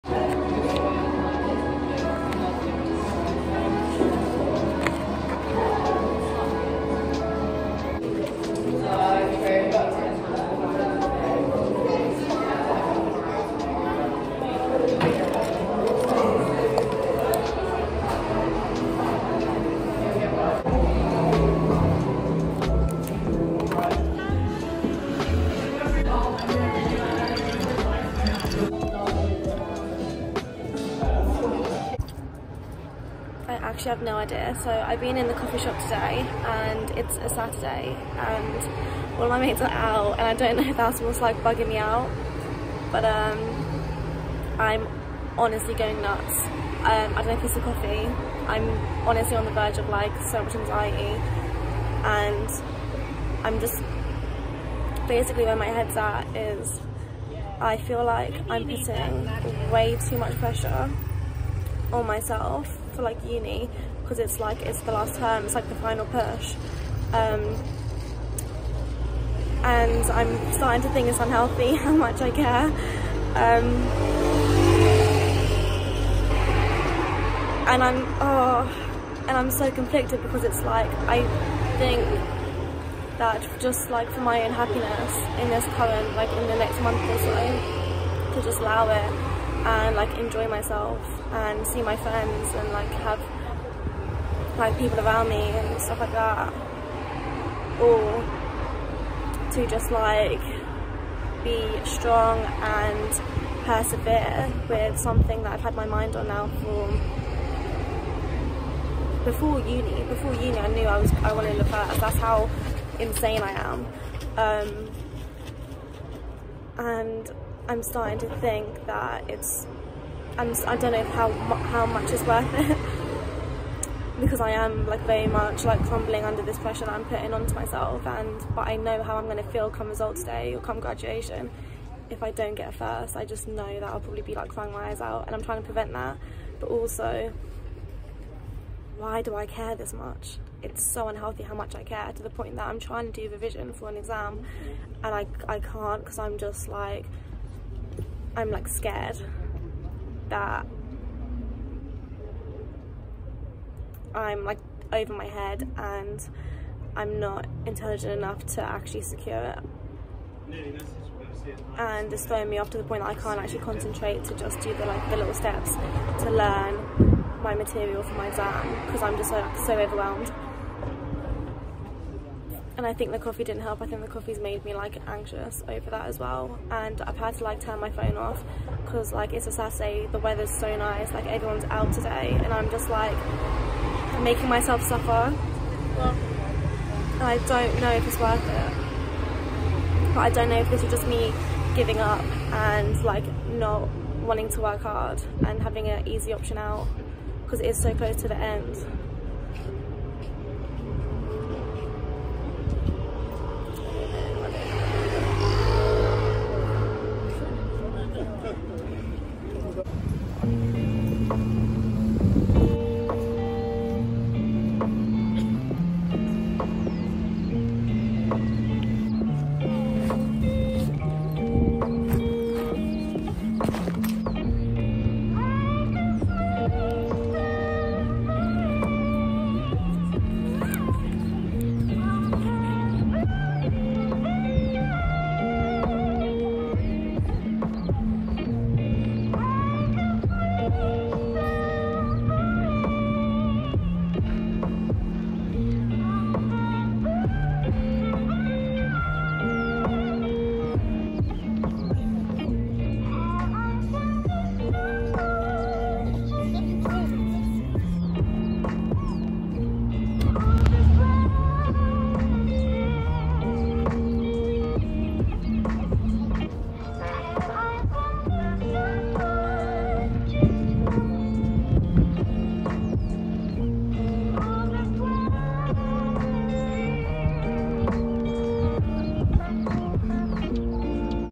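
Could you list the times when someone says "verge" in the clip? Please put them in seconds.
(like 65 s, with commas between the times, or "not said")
49 s.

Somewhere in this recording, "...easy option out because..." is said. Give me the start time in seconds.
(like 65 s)
196 s.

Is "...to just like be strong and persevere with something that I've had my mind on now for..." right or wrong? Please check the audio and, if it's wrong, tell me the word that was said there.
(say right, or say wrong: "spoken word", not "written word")
right.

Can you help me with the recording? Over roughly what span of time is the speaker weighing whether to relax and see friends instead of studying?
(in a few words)
next month or so.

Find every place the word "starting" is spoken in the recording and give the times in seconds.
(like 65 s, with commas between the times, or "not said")
70 s, 117 s.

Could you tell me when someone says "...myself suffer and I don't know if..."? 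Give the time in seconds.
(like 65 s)
184 s.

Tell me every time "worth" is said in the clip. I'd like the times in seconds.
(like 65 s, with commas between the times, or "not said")
122 s, 188 s.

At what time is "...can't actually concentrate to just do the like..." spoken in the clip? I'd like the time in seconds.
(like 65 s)
163 s.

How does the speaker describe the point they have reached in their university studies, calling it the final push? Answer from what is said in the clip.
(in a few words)
last term.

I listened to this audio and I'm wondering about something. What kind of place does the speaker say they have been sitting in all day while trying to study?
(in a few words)
coffee shop.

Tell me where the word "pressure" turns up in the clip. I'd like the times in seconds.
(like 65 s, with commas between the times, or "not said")
60 s, 126 s.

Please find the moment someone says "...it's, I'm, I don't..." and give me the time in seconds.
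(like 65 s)
119 s.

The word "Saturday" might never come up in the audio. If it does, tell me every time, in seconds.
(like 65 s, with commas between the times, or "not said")
37 s, 179 s.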